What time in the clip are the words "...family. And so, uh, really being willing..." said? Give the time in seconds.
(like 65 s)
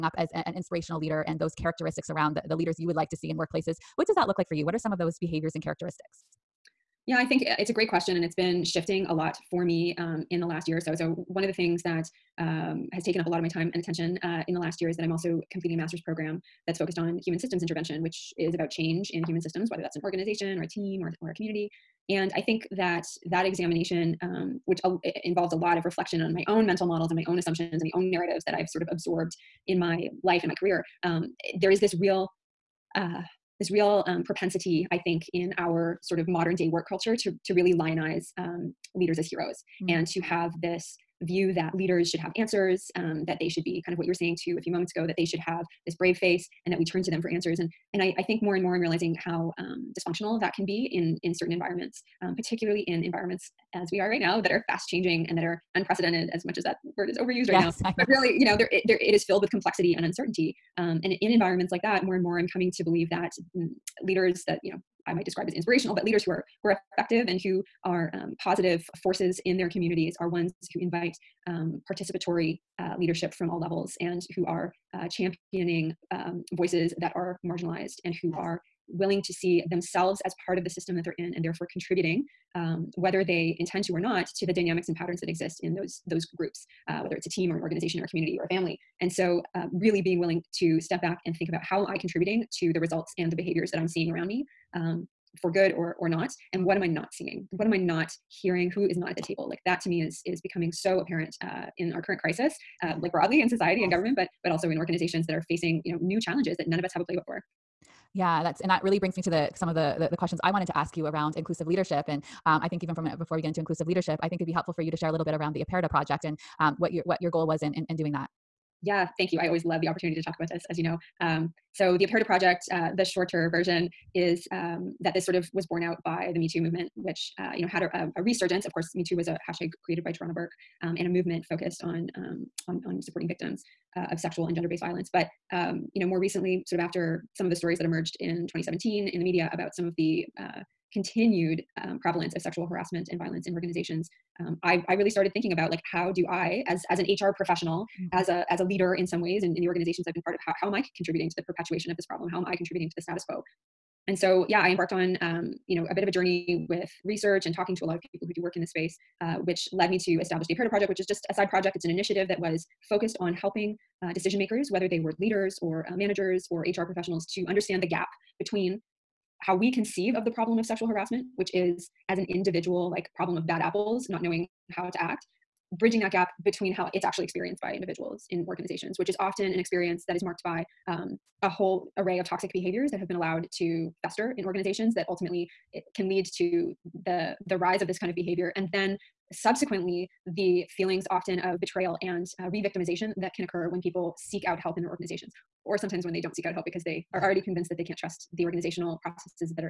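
88 s.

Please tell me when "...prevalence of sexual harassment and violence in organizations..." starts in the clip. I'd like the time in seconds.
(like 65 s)
142 s.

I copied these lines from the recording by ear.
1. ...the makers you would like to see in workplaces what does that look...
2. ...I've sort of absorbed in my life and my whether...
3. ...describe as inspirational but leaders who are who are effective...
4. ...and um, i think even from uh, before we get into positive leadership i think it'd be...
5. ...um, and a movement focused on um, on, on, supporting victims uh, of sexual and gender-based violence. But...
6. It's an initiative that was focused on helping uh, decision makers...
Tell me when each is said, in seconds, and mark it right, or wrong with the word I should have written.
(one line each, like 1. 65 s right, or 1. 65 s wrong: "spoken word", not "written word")
1. 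2 s wrong: "leaders", not "makers"
2. 28 s wrong: "career", not "whether"
3. 65 s right
4. 112 s wrong: "inclusive", not "positive"
5. 130 s right
6. 161 s right.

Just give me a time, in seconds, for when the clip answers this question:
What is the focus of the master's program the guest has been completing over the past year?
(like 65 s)
17 s.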